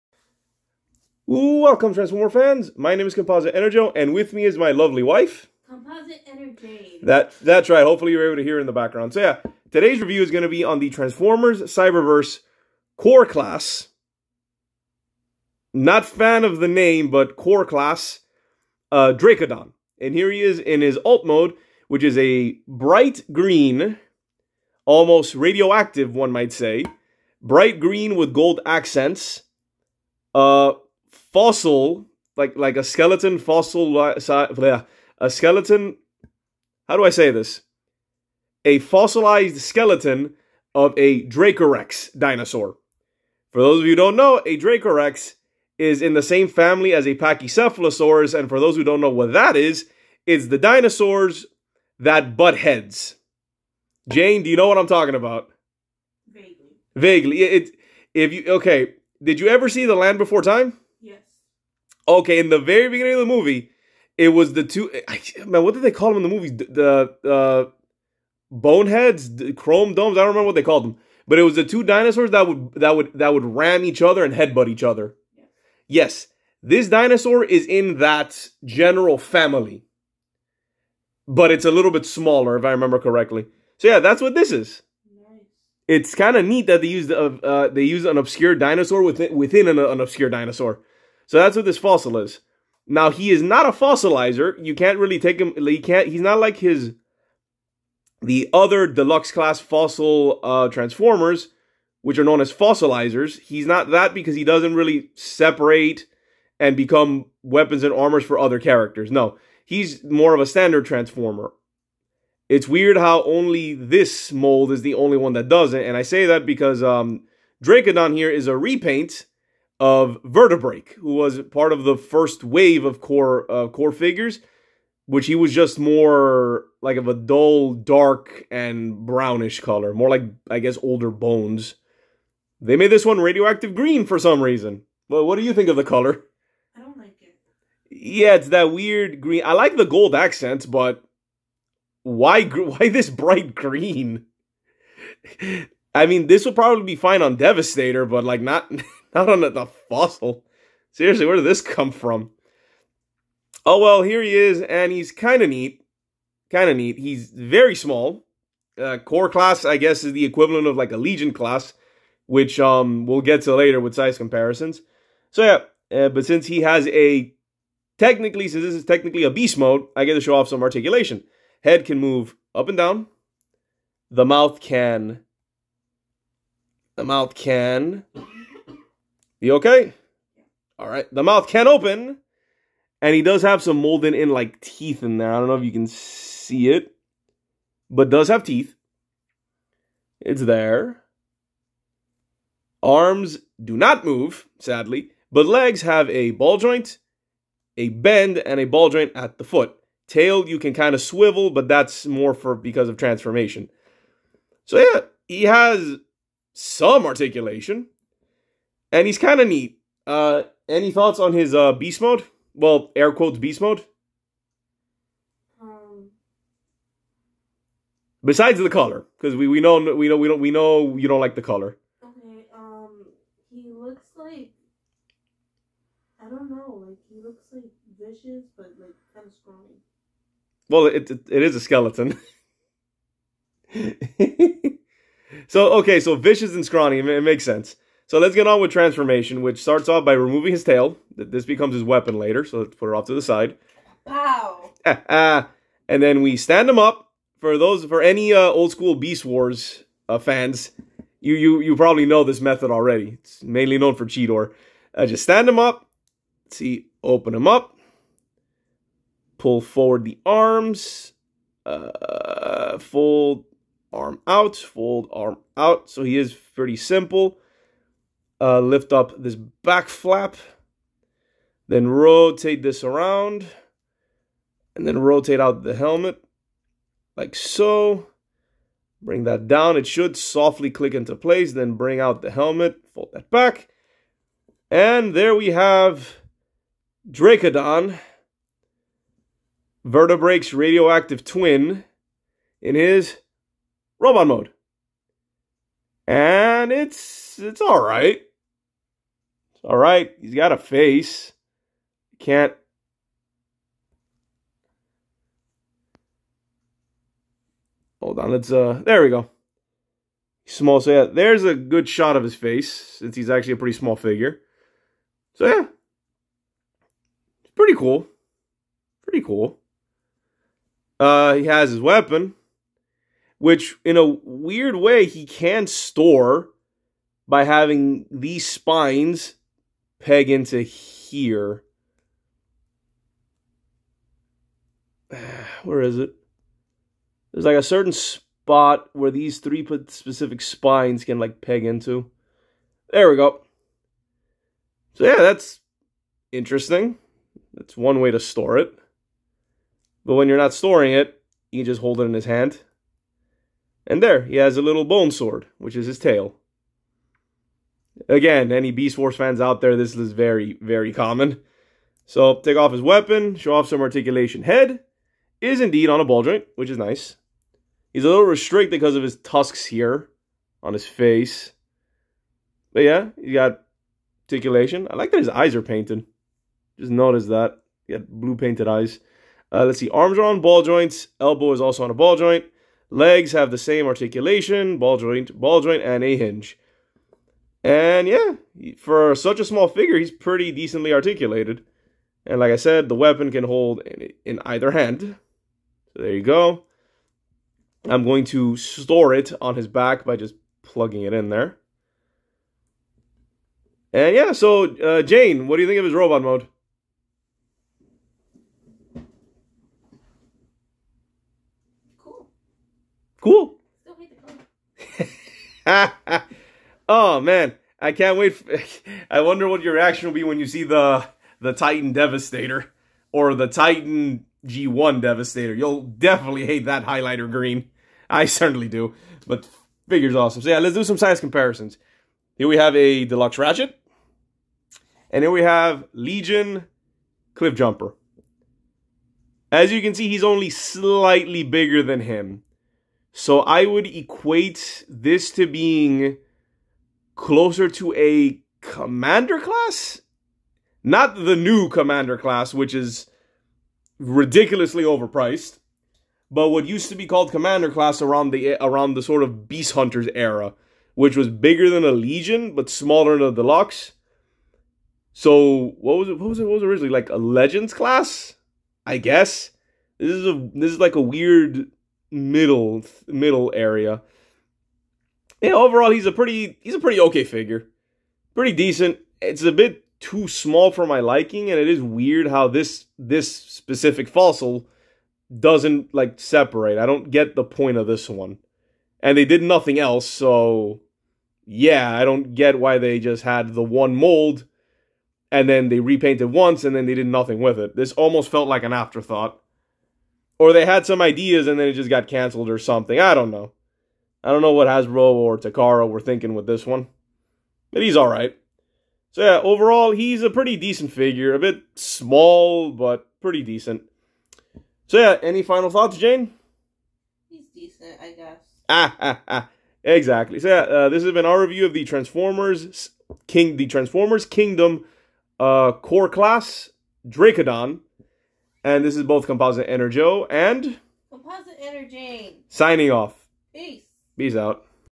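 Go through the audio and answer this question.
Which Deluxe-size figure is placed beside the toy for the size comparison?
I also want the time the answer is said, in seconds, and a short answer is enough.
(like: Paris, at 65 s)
Ratchet, at 433 s.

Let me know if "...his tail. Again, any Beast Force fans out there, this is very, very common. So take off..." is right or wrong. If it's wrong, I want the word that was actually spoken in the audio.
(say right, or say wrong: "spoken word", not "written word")
right.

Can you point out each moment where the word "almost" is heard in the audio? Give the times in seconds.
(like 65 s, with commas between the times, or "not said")
24 s, 497 s.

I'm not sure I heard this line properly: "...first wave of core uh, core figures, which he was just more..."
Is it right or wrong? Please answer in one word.
right.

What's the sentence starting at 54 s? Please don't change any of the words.
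Jane, do you know what I'm talking about?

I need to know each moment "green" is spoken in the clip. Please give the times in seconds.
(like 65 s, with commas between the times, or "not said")
23 s, 27 s, 133 s, 139 s, 143 s, 427 s.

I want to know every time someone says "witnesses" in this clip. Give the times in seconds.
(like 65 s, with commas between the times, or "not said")
not said.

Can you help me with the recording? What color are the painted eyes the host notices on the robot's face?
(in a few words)
blue.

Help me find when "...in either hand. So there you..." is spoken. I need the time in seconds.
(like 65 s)
394 s.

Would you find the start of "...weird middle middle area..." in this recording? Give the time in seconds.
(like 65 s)
471 s.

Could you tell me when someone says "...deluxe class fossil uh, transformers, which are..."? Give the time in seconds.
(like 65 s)
98 s.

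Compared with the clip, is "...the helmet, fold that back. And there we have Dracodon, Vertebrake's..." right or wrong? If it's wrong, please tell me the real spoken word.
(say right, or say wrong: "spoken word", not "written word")
right.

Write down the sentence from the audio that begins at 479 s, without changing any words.
It's a bit too small for my liking, and it is weird how this this specific fossil doesn't like separate.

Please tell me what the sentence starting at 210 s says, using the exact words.
Uh, any thoughts on his uh, beast mode?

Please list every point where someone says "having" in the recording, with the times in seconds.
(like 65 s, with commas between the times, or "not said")
327 s.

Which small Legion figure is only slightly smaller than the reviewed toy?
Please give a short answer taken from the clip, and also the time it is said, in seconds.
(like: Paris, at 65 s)
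Cliff Jumper, at 437 s.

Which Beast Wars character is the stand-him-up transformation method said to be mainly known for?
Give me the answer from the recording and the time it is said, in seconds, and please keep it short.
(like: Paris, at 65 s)
Cheetor, at 254 s.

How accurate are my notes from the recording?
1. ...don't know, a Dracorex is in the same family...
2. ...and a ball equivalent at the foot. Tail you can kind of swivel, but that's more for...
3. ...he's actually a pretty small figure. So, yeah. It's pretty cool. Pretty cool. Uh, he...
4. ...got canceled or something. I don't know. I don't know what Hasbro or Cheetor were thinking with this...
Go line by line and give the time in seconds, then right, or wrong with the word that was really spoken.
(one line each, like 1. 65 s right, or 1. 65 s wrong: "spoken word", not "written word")
1. 43 s right
2. 198 s wrong: "joint", not "equivalent"
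3. 313 s right
4. 501 s wrong: "Takara", not "Cheetor".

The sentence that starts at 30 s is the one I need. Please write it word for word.
Uh, fossil, like like a skeleton fossil, a skeleton.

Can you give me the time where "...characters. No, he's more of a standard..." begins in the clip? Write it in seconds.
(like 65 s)
108 s.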